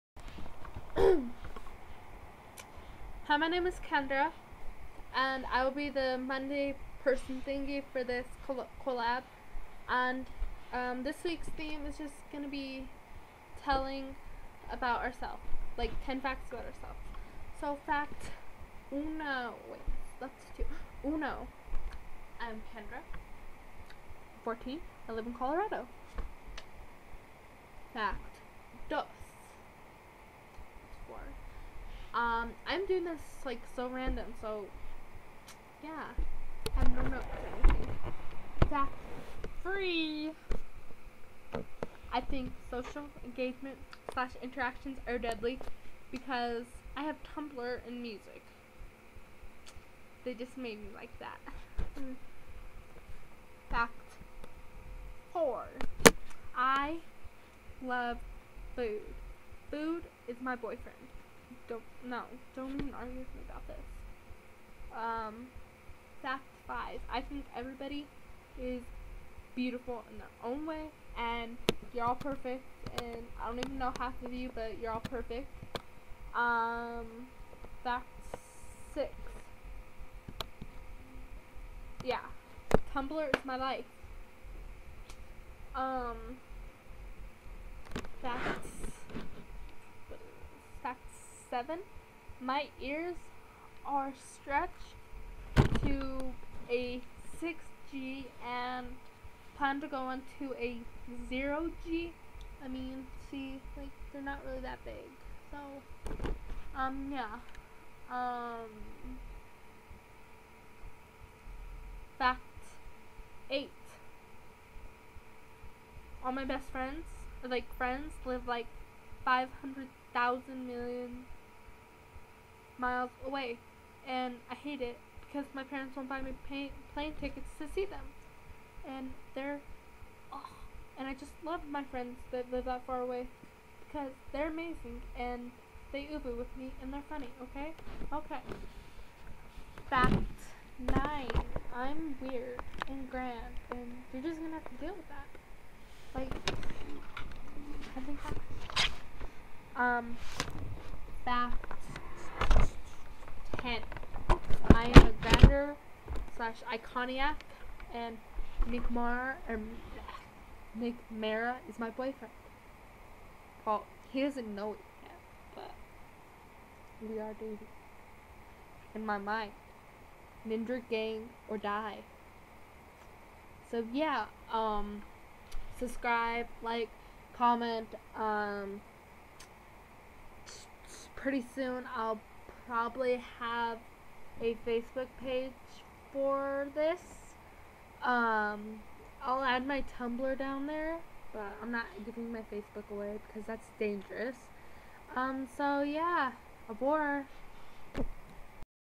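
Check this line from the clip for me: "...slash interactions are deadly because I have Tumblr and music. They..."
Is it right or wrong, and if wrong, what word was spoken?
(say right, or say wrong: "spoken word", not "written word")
right.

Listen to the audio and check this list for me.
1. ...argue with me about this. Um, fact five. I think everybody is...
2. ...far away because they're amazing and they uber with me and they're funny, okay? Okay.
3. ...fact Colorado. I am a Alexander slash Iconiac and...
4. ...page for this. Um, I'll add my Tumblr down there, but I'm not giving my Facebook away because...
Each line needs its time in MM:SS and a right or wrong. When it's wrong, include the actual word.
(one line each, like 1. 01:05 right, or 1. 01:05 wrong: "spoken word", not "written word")
1. 01:02 right
2. 02:12 right
3. 02:31 wrong: "Kent", not "Colorado"
4. 03:05 right.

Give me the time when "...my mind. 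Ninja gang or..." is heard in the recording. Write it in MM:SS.
02:49.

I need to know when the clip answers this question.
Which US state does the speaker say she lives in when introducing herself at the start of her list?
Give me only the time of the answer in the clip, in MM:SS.
00:25.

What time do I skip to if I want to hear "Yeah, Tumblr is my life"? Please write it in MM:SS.
01:22.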